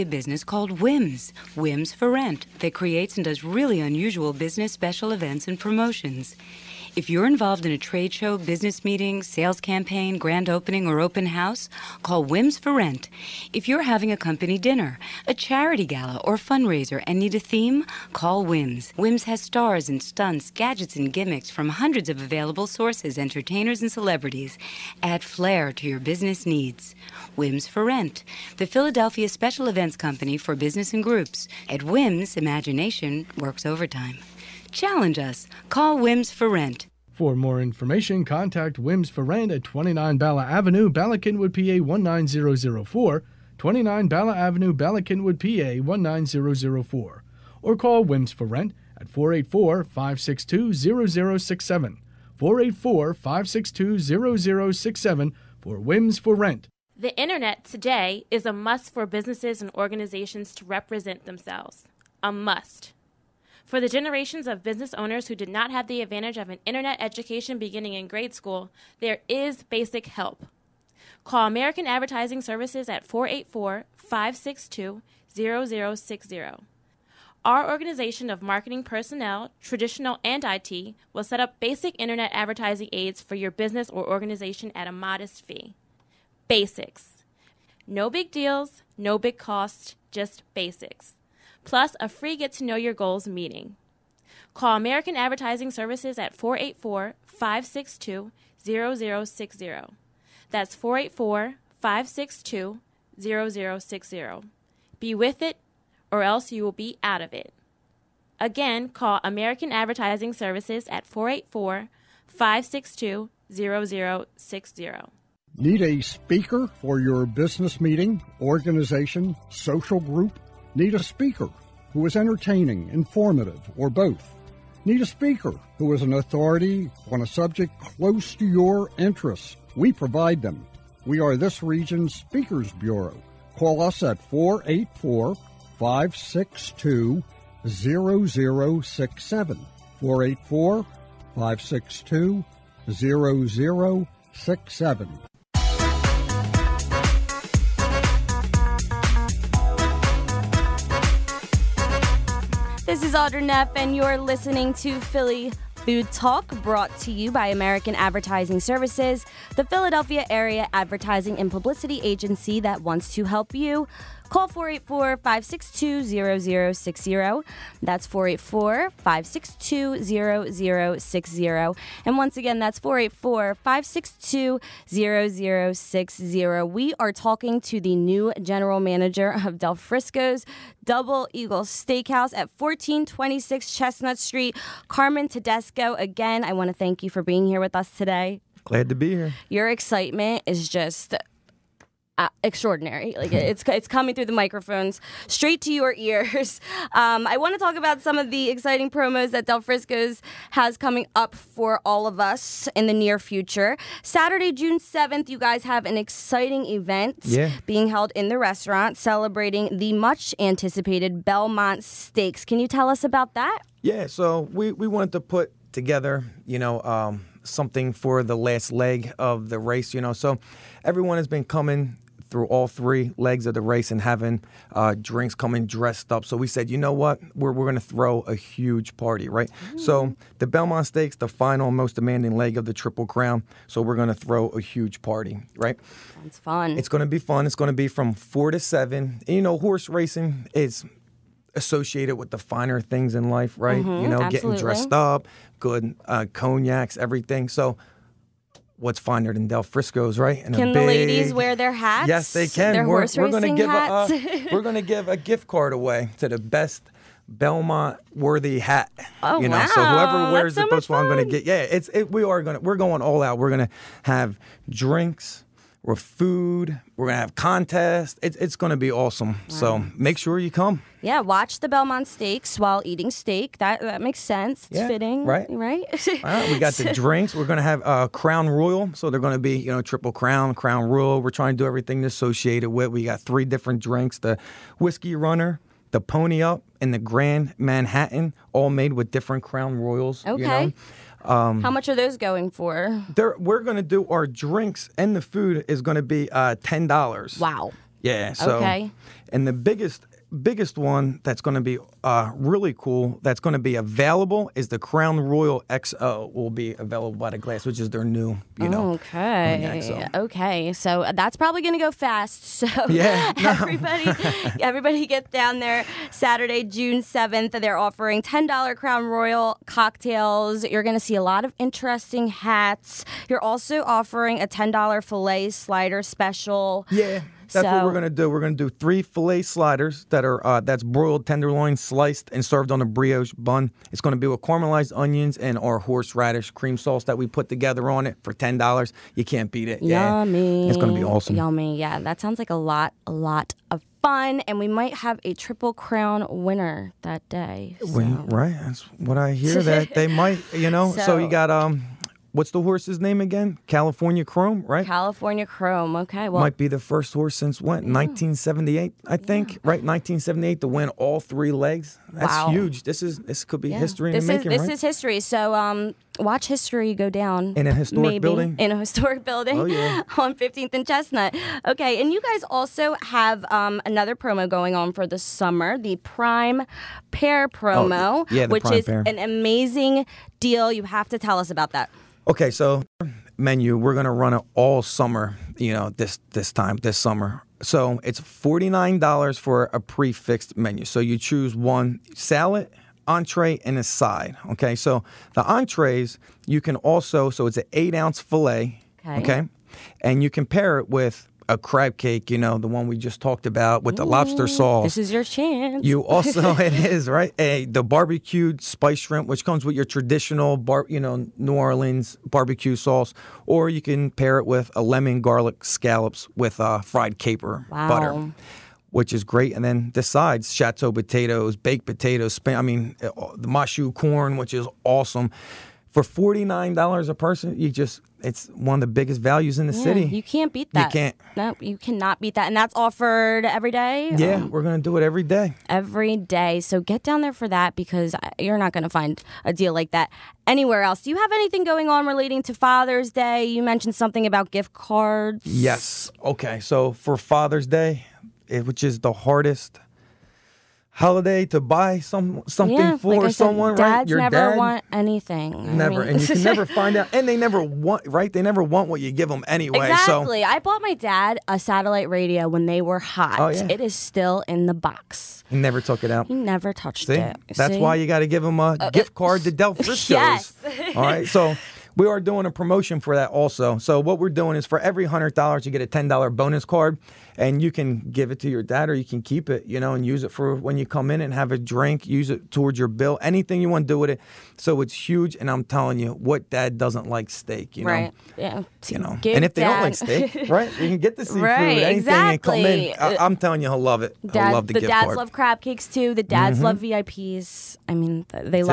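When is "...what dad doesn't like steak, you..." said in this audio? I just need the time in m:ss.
8:06.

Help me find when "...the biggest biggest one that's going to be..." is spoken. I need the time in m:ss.
4:59.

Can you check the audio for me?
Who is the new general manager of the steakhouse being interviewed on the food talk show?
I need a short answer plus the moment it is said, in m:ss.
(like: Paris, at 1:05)
Carmen Tedesco, at 3:04.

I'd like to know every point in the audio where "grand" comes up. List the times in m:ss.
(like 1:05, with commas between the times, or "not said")
0:10, 4:46.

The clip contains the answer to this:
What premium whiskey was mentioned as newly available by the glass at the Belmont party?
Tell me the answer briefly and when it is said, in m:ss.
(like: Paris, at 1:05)
Crown Royal XO, at 5:04.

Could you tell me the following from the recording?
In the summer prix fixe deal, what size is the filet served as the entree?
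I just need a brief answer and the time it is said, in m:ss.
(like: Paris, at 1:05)
8 ounce, at 6:37.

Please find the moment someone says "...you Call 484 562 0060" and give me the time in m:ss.
2:43.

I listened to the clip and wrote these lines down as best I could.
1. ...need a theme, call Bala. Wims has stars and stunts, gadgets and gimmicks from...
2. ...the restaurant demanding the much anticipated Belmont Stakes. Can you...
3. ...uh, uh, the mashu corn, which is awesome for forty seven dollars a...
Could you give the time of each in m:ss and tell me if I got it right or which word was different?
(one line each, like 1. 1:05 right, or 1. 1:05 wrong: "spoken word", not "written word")
1. 0:17 wrong: "Wims", not "Bala"
2. 3:28 wrong: "celebrating", not "demanding"
3. 7:03 wrong: "nine", not "seven".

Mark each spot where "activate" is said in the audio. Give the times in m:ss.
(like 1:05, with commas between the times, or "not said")
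not said.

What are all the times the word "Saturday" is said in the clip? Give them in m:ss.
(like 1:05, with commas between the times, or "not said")
3:24, 5:16.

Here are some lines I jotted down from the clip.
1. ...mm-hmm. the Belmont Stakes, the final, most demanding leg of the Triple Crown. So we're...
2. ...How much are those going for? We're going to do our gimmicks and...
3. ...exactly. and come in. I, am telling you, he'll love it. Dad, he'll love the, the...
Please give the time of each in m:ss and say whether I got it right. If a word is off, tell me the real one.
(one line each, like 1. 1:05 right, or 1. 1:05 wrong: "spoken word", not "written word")
1. 3:50 right
2. 4:51 wrong: "drinks", not "gimmicks"
3. 8:11 right.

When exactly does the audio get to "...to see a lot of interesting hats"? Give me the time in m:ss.
5:20.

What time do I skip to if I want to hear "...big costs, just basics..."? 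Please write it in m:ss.
1:29.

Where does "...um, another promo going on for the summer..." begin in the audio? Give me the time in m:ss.
6:13.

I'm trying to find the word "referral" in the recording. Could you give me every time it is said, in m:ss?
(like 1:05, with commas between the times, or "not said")
not said.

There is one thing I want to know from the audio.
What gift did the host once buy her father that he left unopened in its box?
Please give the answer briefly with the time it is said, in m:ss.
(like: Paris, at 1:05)
satellite radio, at 7:41.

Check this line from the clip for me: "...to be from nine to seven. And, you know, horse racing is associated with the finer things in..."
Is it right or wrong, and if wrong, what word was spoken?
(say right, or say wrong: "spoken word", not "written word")
wrong: "four", not "nine".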